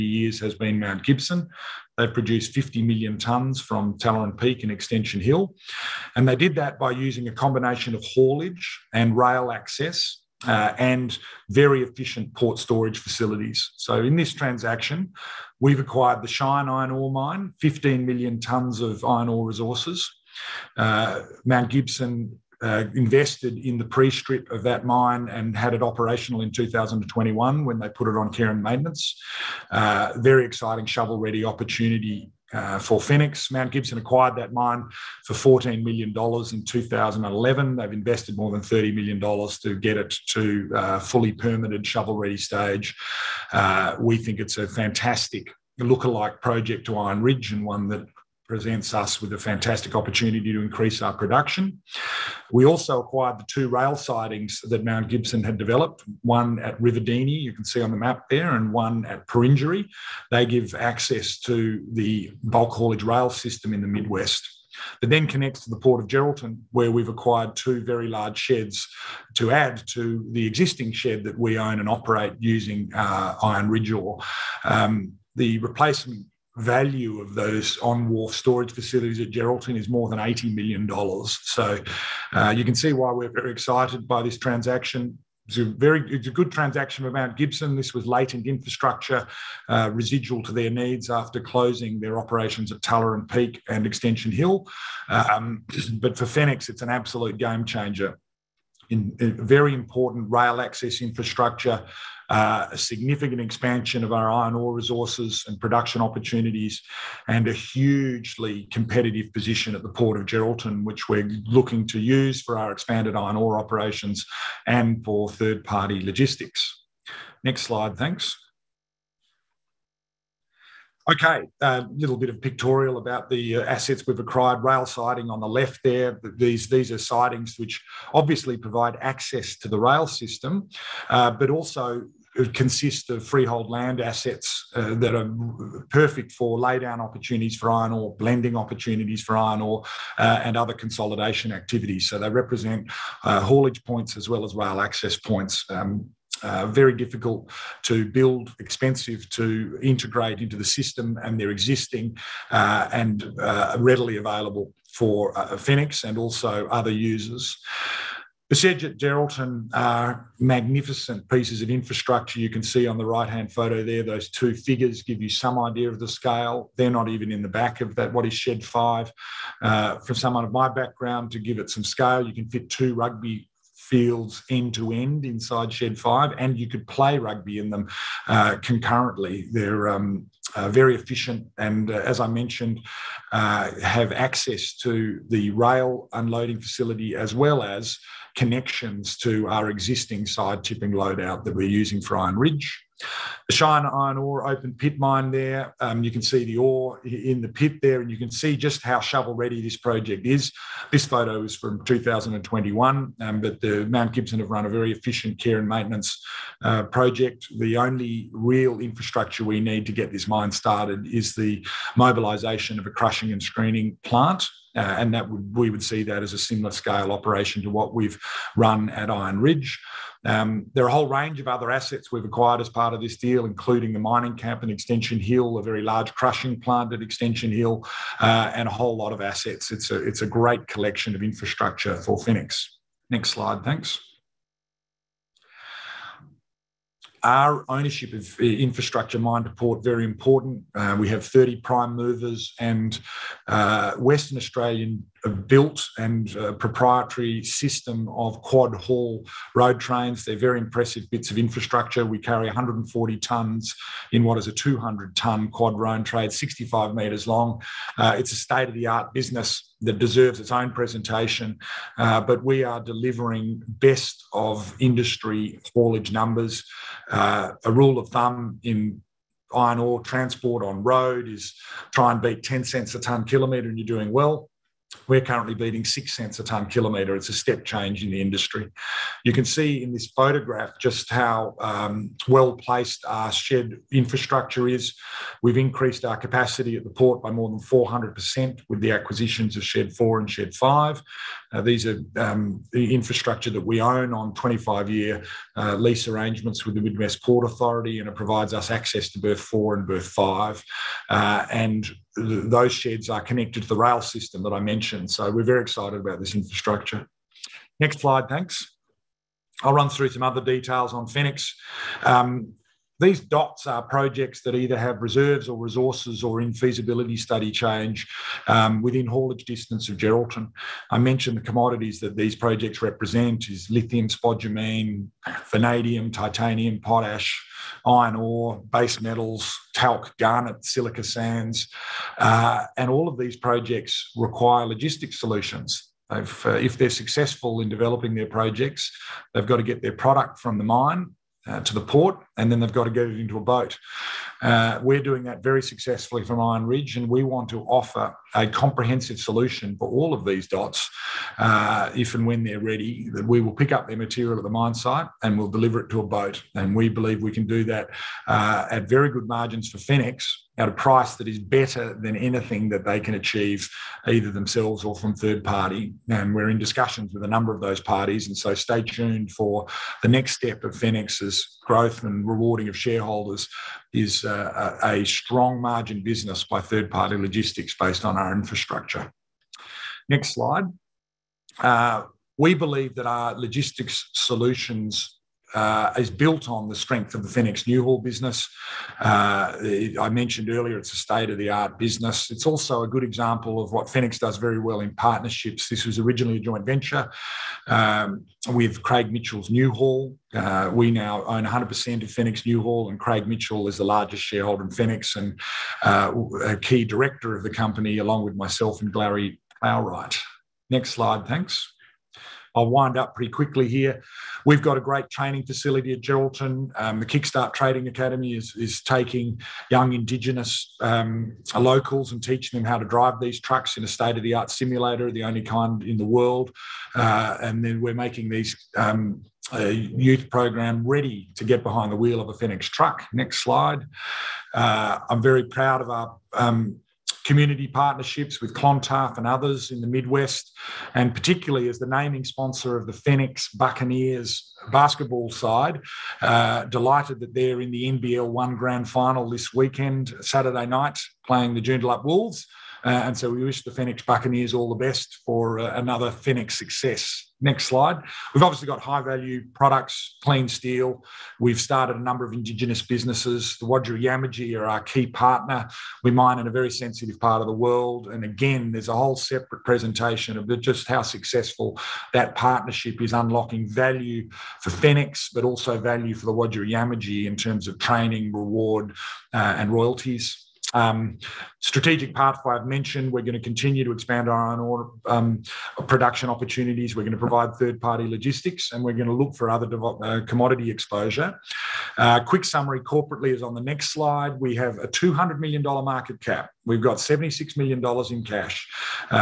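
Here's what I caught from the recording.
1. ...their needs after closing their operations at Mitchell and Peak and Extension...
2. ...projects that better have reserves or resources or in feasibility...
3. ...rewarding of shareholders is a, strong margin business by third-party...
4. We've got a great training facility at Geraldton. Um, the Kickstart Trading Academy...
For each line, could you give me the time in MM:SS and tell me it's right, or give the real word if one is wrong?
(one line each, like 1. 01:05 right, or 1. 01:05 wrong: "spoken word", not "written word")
1. 01:30 wrong: "Tuller", not "Mitchell"
2. 05:13 wrong: "either", not "better"
3. 06:12 right
4. 06:54 right.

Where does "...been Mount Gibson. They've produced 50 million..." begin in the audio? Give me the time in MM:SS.
00:00.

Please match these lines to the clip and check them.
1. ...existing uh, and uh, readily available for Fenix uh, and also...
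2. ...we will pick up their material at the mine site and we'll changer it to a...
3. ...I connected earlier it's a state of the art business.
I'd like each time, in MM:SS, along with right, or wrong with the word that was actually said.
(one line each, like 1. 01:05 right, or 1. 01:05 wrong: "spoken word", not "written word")
1. 02:31 right
2. 05:53 wrong: "deliver", not "changer"
3. 06:29 wrong: "mentioned", not "connected".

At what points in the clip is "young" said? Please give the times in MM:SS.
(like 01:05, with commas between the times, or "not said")
06:59.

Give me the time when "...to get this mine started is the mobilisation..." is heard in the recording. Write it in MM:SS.
03:29.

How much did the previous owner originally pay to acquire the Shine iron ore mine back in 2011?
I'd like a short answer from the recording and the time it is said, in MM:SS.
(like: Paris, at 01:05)
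$14 million, at 00:35.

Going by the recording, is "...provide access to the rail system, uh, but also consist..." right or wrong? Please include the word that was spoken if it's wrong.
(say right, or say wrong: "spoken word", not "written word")
right.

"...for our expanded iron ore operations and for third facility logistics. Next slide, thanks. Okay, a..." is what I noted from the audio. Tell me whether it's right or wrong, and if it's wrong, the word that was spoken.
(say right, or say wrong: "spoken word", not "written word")
wrong: "party", not "facility".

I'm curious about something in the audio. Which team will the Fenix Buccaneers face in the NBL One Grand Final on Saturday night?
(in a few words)
Joondalup Wolves.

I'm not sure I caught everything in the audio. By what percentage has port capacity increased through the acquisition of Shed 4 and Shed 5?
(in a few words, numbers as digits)
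More than 400%.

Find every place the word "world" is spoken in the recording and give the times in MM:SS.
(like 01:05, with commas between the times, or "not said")
07:06, 07:47.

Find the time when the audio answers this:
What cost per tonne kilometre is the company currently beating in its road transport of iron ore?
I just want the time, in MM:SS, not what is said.
04:35.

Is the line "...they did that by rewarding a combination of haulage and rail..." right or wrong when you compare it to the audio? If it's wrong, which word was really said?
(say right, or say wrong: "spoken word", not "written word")
wrong: "using", not "rewarding".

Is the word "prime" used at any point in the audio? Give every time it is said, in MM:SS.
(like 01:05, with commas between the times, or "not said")
04:01.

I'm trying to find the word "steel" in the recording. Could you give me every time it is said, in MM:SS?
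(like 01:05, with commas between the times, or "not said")
07:40.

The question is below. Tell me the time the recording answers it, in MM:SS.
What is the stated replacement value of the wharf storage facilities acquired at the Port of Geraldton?
01:19.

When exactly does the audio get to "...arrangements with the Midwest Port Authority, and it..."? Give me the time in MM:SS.
04:56.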